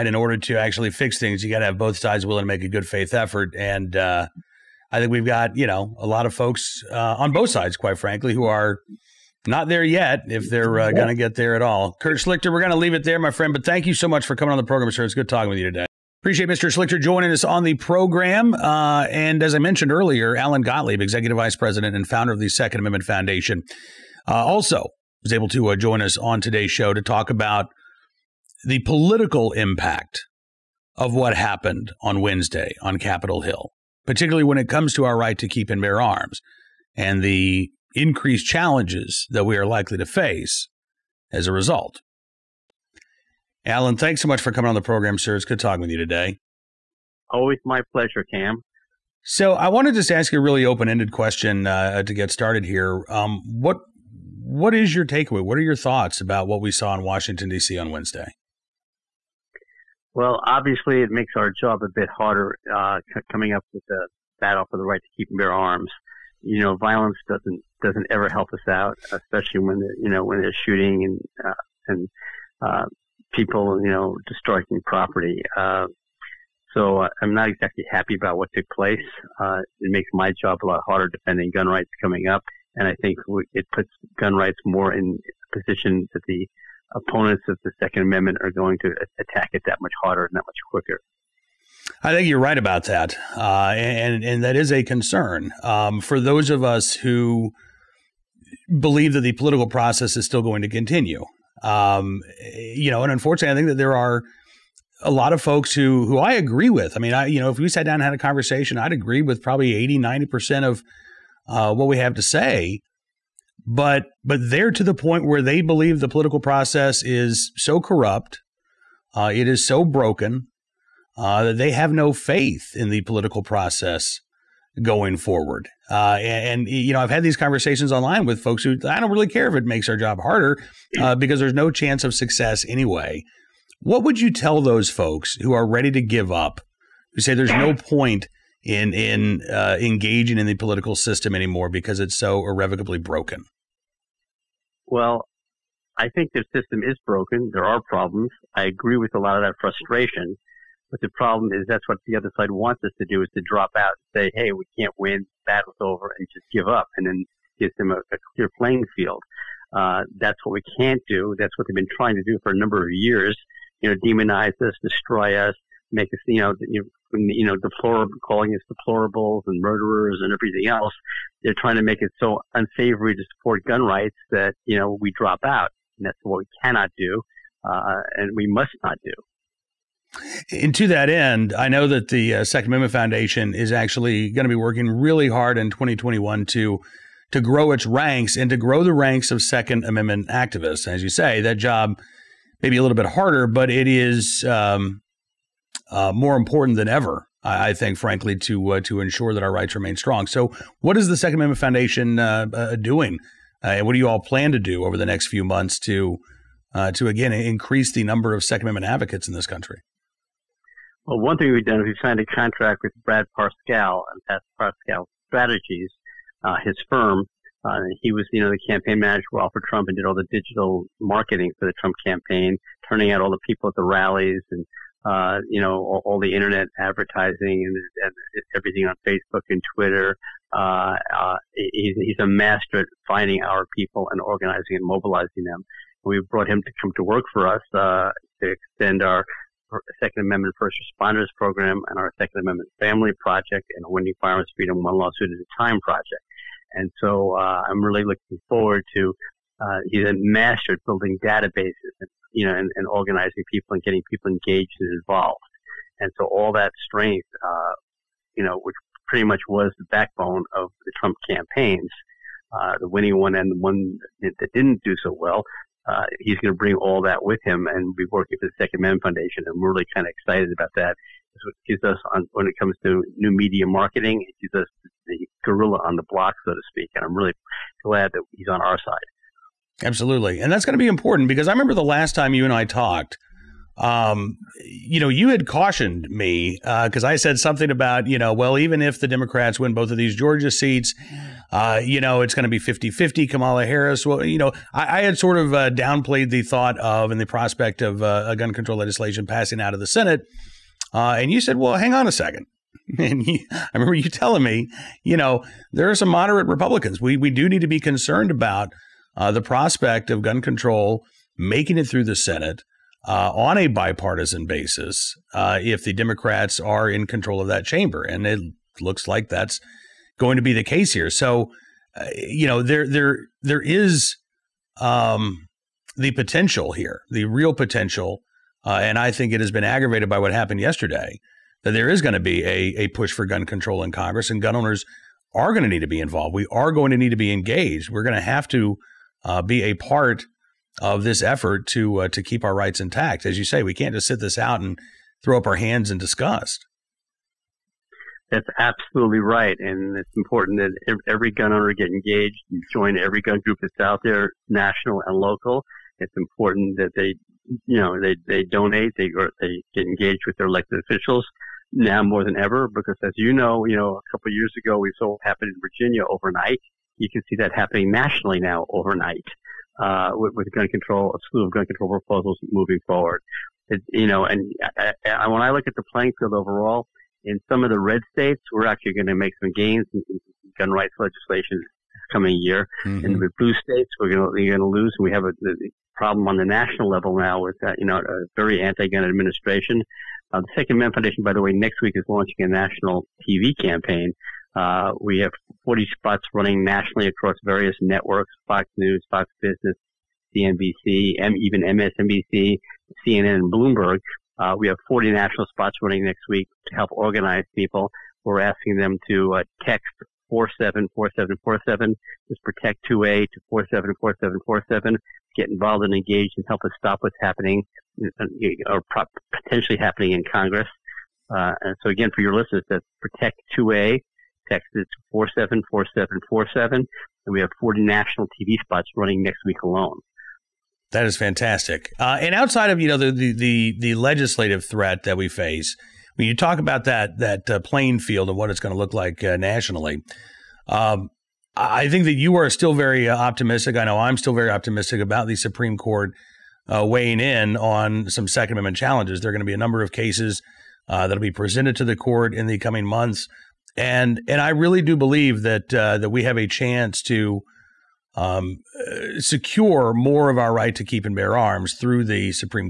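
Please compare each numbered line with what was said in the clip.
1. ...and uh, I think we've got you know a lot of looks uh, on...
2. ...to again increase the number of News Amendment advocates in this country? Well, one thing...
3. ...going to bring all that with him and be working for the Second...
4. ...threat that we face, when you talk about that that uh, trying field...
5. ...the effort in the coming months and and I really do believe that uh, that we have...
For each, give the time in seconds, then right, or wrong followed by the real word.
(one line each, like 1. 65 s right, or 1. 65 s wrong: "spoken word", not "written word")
1. 3 s wrong: "folks", not "looks"
2. 206 s wrong: "Second", not "News"
3. 266 s right
4. 434 s wrong: "playing", not "trying"
5. 451 s wrong: "court", not "effort".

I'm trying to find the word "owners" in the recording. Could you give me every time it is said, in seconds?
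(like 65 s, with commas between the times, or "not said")
334 s, 351 s.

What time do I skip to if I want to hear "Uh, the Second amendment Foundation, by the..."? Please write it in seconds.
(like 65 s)
390 s.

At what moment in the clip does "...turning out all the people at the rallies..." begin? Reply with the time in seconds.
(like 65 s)
222 s.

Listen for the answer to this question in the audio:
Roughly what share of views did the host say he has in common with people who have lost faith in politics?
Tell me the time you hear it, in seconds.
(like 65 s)
109 s.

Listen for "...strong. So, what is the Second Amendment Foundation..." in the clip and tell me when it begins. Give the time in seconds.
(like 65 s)
199 s.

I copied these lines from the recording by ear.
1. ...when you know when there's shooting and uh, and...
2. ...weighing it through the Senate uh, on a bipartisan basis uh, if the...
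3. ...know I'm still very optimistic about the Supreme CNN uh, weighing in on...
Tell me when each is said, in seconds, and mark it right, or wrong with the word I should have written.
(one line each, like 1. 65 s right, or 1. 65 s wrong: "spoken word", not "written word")
1. 69 s right
2. 311 s wrong: "making", not "weighing"
3. 443 s wrong: "Court", not "CNN".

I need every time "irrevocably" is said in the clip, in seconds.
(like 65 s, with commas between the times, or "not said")
142 s.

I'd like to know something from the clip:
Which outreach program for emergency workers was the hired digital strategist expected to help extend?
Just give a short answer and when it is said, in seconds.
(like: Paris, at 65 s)
Second Amendment First Responders Program, at 240 s.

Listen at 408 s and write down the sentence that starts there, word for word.
We're asking them to uh, text 474747.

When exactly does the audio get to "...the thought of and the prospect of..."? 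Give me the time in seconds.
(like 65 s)
296 s.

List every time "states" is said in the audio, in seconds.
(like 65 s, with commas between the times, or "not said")
378 s, 383 s.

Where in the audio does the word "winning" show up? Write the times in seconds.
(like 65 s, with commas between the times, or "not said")
243 s, 262 s.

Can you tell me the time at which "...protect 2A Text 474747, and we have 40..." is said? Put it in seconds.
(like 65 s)
423 s.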